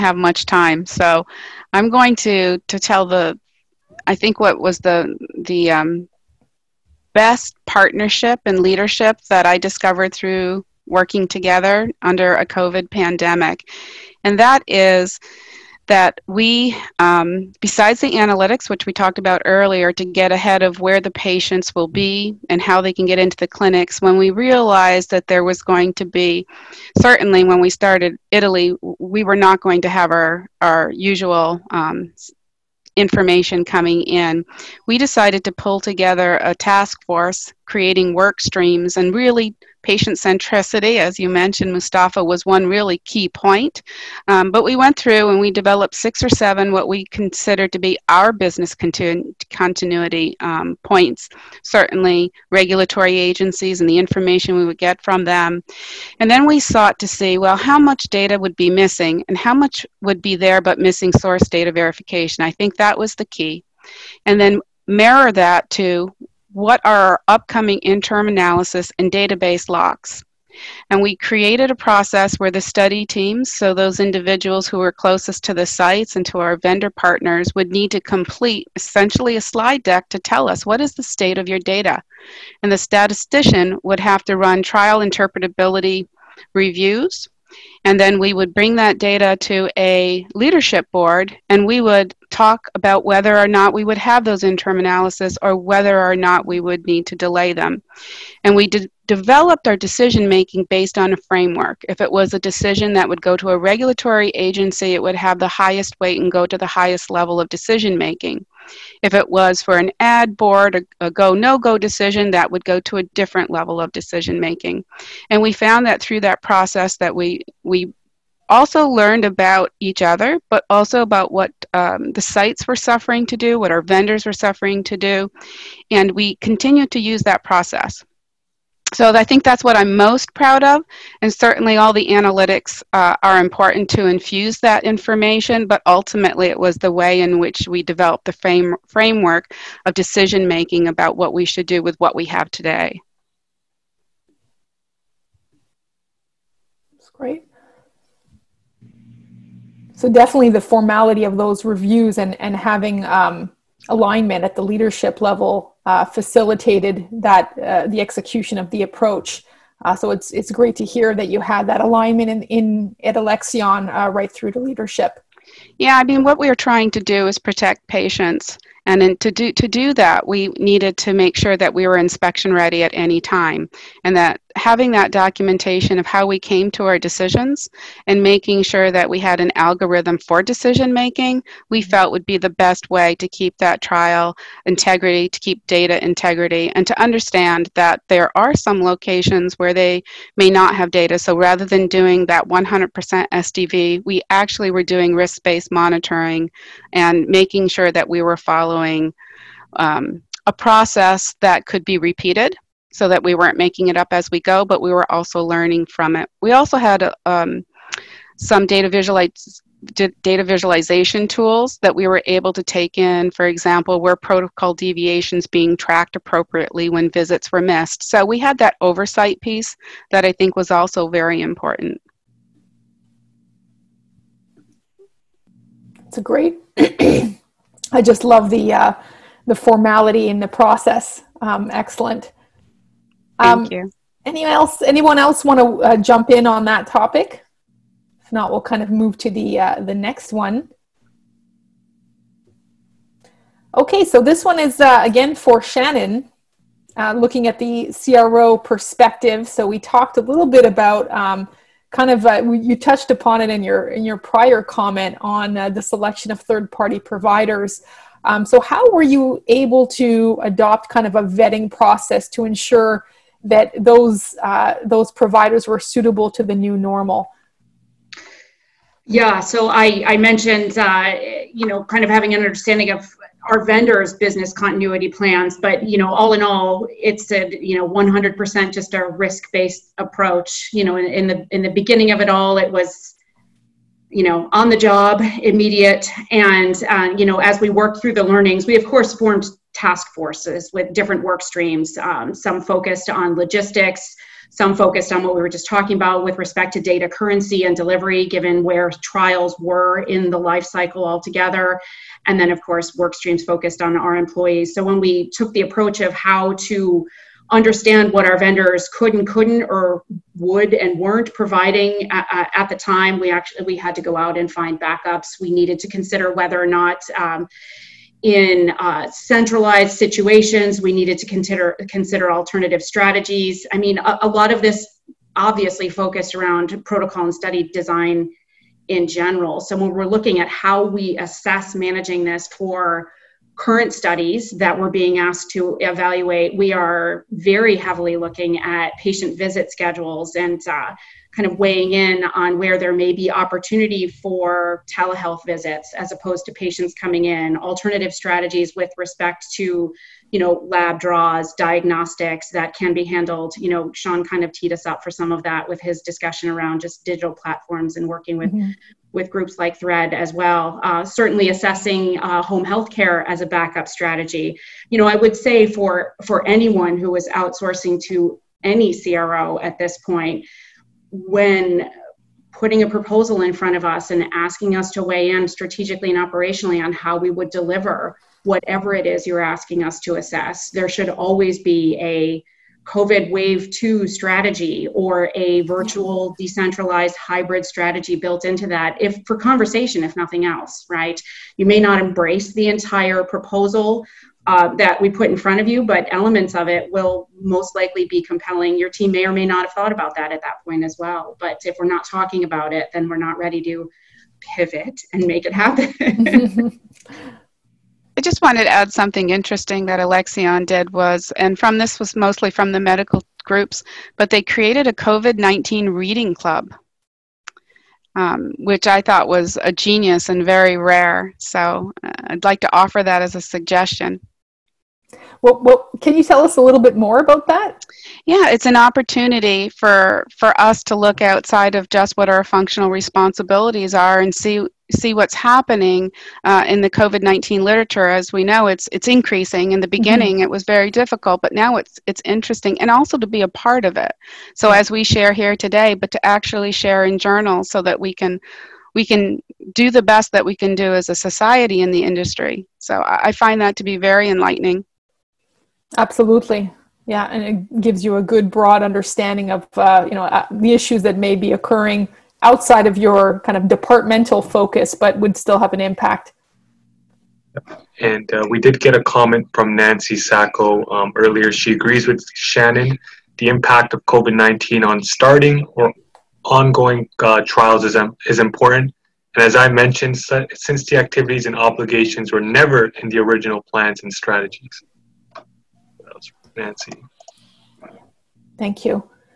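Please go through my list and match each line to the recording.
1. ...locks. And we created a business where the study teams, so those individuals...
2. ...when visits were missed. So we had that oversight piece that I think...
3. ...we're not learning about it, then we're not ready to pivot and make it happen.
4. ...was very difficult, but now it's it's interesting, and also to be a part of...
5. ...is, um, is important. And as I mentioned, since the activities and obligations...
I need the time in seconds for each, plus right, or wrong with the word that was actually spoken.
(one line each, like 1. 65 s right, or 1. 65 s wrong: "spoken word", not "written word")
1. 69 s wrong: "process", not "business"
2. 216 s right
3. 401 s wrong: "talking", not "learning"
4. 440 s right
5. 477 s right.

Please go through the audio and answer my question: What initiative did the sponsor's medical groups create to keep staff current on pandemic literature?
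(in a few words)
COVID-19 reading club.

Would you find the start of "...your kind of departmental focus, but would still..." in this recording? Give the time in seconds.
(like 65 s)
462 s.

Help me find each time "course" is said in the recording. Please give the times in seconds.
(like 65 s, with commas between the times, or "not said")
288 s, 302 s.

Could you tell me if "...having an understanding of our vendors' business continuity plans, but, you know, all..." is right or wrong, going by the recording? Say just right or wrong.
right.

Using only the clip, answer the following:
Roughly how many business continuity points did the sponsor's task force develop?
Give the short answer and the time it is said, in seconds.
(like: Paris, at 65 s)
6 or 7, at 45 s.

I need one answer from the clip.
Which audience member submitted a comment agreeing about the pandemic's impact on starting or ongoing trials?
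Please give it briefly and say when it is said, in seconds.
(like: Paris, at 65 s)
Nancy Sacco, at 469 s.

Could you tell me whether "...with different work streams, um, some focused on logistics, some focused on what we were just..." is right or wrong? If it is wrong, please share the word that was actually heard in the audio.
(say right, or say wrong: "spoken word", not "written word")
right.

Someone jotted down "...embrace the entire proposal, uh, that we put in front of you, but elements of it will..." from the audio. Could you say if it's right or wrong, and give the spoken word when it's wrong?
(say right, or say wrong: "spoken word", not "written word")
right.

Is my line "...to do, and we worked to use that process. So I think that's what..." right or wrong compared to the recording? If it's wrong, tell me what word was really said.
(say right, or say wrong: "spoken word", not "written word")
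wrong: "continued", not "worked".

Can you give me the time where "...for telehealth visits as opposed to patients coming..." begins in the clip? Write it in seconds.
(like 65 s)
344 s.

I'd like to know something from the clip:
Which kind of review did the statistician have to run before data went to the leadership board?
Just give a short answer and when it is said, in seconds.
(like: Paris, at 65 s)
trial interpretability reviews, at 84 s.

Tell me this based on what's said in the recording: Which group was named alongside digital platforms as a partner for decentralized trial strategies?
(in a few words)
Thread.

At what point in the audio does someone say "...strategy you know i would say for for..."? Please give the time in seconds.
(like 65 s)
363 s.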